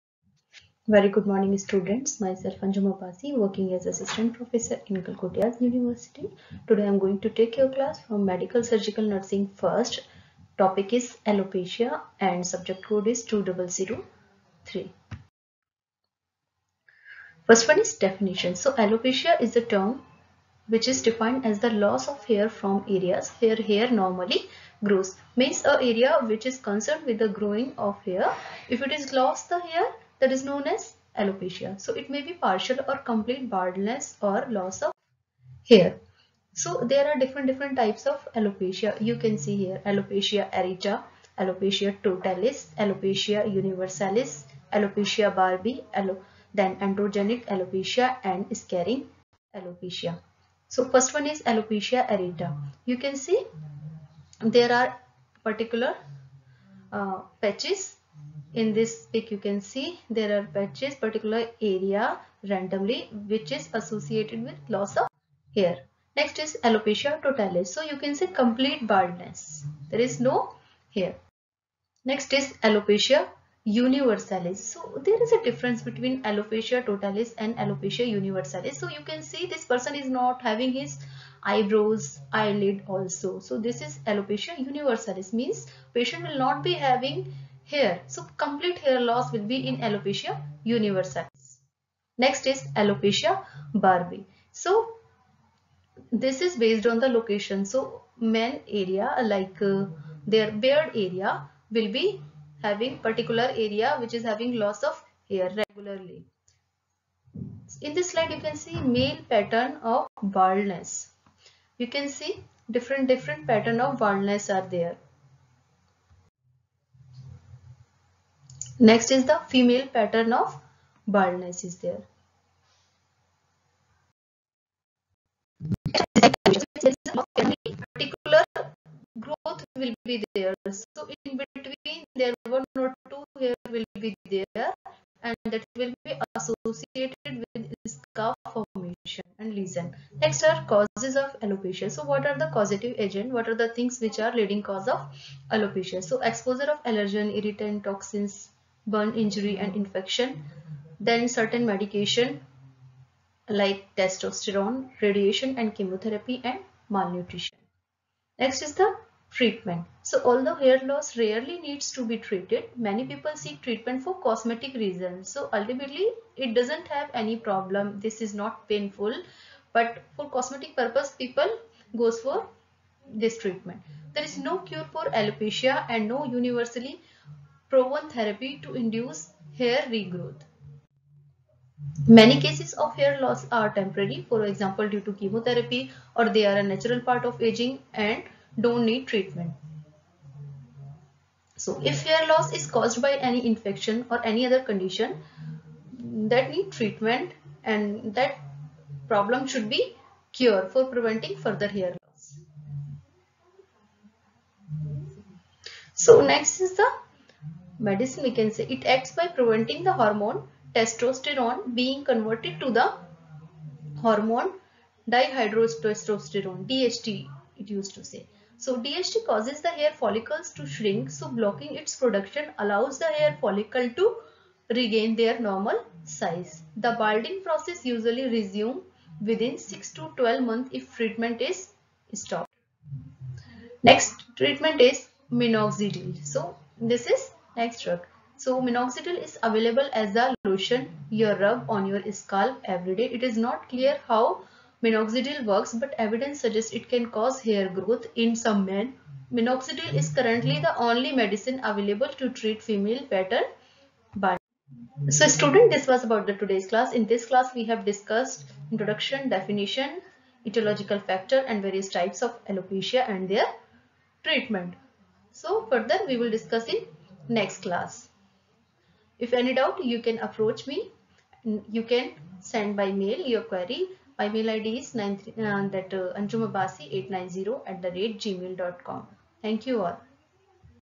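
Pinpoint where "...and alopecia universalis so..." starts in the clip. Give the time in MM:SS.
01:17.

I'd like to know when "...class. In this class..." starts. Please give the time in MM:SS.
04:16.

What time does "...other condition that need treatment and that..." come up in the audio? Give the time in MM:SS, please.
03:14.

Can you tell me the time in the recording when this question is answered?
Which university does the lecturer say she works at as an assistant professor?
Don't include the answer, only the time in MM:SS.
00:05.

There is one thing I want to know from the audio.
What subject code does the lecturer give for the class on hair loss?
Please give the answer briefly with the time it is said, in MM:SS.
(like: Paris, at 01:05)
2003, at 00:13.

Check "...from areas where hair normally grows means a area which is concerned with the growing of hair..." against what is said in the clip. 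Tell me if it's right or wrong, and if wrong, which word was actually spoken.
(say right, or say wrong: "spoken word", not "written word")
right.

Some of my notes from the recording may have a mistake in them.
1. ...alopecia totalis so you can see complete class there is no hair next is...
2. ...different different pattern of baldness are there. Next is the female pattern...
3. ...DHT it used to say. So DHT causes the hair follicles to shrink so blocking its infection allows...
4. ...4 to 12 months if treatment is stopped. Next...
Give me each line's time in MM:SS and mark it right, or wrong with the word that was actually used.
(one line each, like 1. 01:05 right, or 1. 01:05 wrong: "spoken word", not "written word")
1. 01:06 wrong: "baldness", not "class"
2. 01:52 right
3. 03:36 wrong: "production", not "infection"
4. 03:49 wrong: "6", not "4".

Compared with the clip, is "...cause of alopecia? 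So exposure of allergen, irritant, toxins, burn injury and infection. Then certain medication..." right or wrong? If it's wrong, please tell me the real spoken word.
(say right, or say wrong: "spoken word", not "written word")
right.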